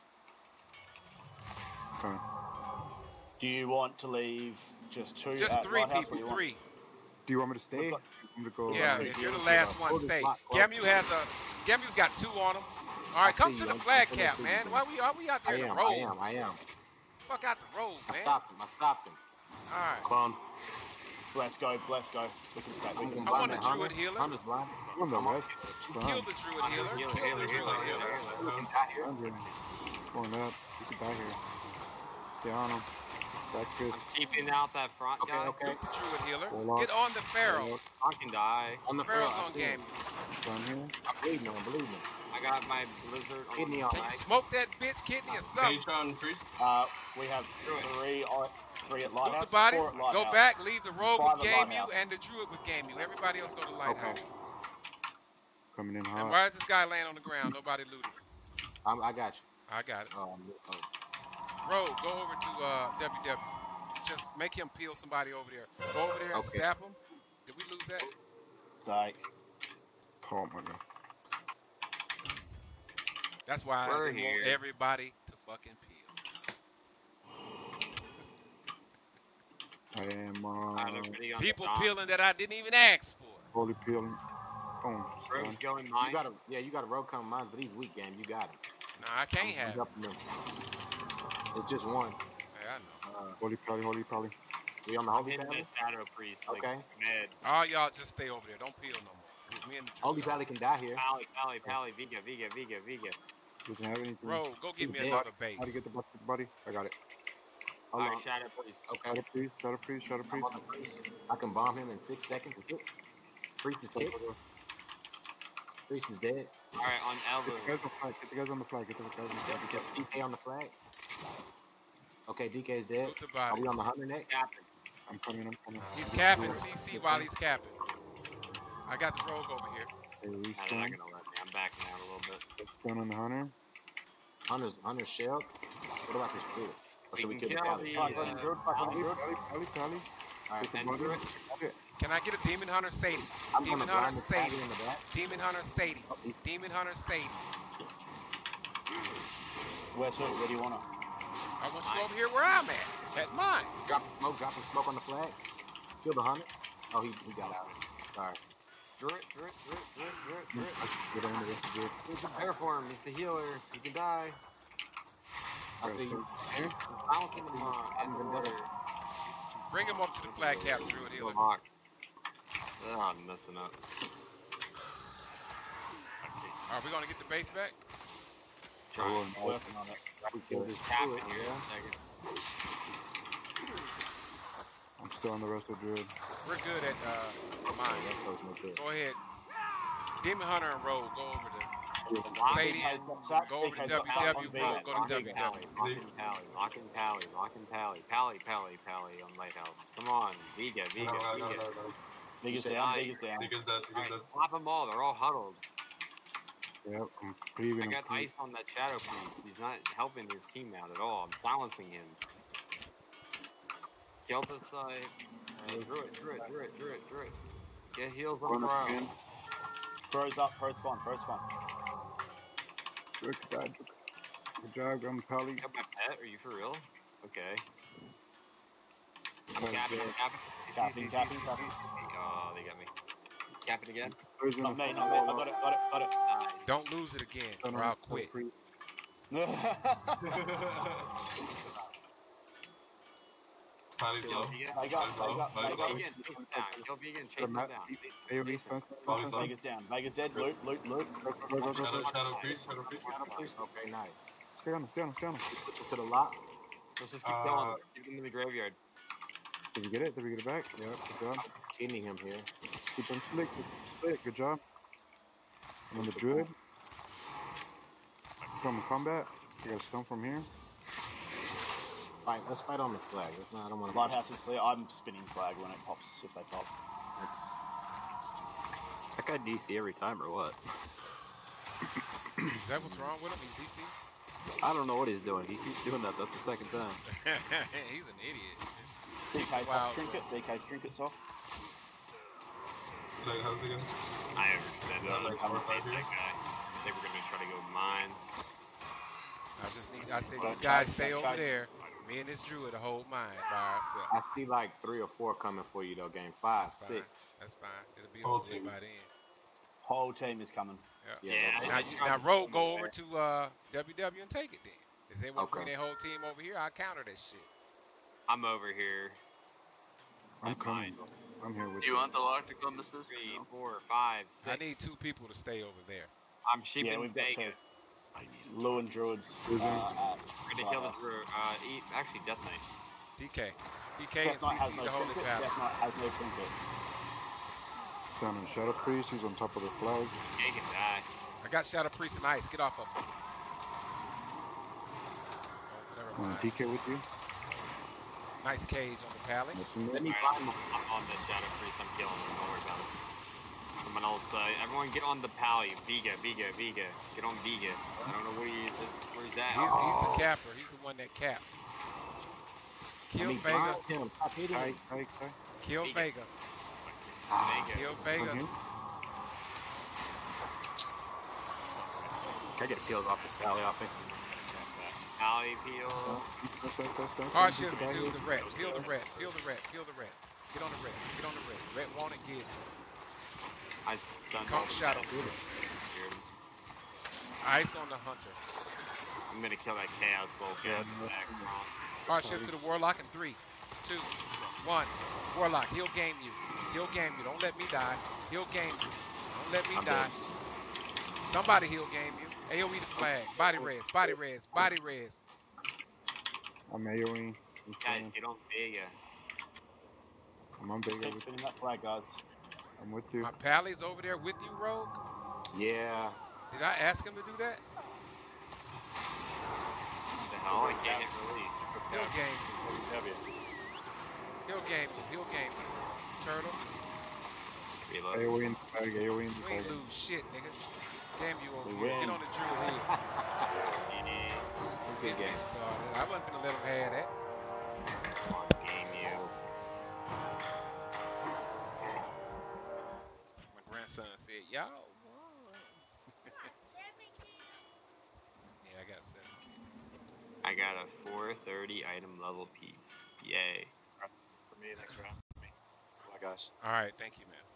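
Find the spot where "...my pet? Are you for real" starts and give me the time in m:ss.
3:45.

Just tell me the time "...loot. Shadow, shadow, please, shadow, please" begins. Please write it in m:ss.
4:10.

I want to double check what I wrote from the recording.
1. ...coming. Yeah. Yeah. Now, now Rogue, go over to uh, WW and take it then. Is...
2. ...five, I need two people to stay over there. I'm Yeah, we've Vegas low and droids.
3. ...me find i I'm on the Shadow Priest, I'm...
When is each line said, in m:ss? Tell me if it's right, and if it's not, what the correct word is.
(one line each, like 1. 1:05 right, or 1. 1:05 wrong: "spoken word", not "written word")
1. 5:10 right
2. 5:23 right
3. 5:50 right.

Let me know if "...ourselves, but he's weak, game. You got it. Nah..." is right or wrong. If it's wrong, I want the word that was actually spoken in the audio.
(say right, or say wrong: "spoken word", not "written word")
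wrong: "mines", not "ourselves".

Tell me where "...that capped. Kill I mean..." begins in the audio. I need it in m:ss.
6:00.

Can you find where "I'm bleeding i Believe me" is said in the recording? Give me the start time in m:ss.
0:41.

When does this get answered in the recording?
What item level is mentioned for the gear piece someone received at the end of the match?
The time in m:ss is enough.
7:31.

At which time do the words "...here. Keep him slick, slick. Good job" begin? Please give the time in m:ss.
4:22.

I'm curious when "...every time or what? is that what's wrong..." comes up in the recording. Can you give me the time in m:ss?
4:39.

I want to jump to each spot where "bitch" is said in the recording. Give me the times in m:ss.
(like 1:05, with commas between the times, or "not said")
0:44.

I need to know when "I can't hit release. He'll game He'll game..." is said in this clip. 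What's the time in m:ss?
7:00.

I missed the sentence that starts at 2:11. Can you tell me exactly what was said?
I'm backing out a little bit.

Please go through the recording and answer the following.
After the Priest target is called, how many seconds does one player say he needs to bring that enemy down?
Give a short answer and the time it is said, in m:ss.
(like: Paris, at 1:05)
6, at 1:52.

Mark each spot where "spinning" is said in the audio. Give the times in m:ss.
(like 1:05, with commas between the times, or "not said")
4:34, 6:51.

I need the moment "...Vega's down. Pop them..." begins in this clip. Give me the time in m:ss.
3:22.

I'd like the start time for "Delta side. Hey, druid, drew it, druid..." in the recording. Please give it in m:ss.
3:34.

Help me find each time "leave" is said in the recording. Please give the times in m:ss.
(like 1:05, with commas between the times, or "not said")
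0:04, 0:50.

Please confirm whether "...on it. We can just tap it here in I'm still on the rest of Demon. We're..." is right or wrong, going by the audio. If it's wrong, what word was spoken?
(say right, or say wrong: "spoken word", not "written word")
wrong: "Druid", not "Demon".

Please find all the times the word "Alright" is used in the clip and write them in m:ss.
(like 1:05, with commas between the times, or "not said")
2:38, 6:32.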